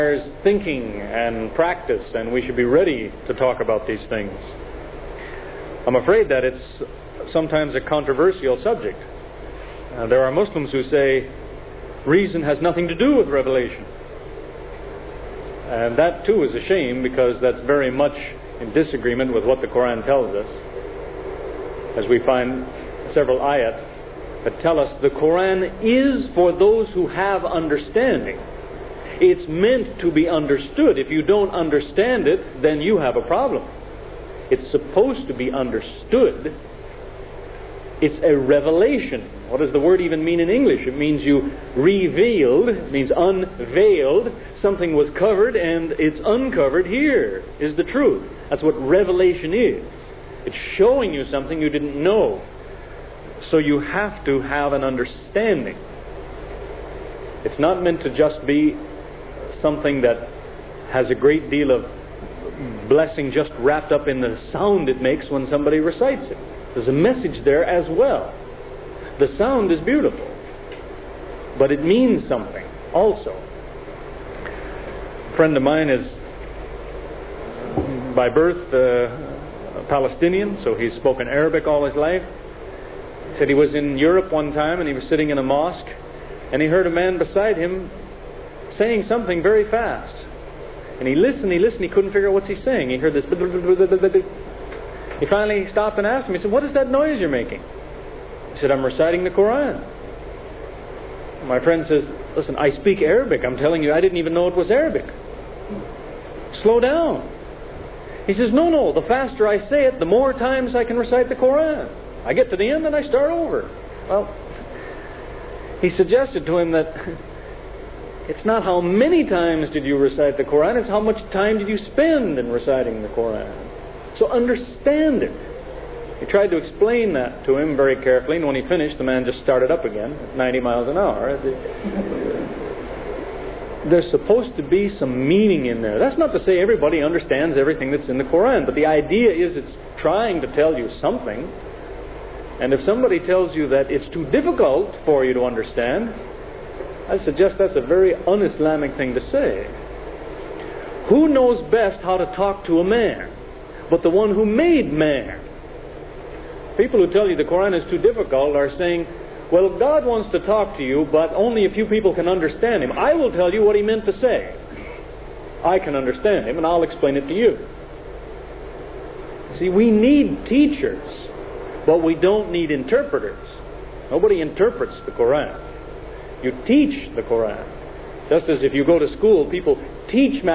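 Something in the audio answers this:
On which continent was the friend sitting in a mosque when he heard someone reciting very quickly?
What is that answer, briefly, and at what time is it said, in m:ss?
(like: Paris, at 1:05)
Europe, at 1:23.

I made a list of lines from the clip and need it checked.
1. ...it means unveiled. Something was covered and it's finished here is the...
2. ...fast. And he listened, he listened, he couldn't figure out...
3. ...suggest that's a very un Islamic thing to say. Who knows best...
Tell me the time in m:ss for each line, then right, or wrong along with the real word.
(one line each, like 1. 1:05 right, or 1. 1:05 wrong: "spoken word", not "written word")
1. 0:42 wrong: "uncovered", not "finished"
2. 1:29 right
3. 2:27 right.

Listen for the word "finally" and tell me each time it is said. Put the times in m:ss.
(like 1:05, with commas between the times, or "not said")
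1:35.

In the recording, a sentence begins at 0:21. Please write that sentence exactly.
As we find several ayat that tell us the Quran is for those who have understanding.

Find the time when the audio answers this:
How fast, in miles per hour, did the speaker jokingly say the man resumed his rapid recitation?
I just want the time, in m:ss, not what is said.
2:10.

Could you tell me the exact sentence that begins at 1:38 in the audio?
He said, I'm reciting the Quran.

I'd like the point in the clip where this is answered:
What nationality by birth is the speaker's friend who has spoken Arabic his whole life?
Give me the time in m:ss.
1:19.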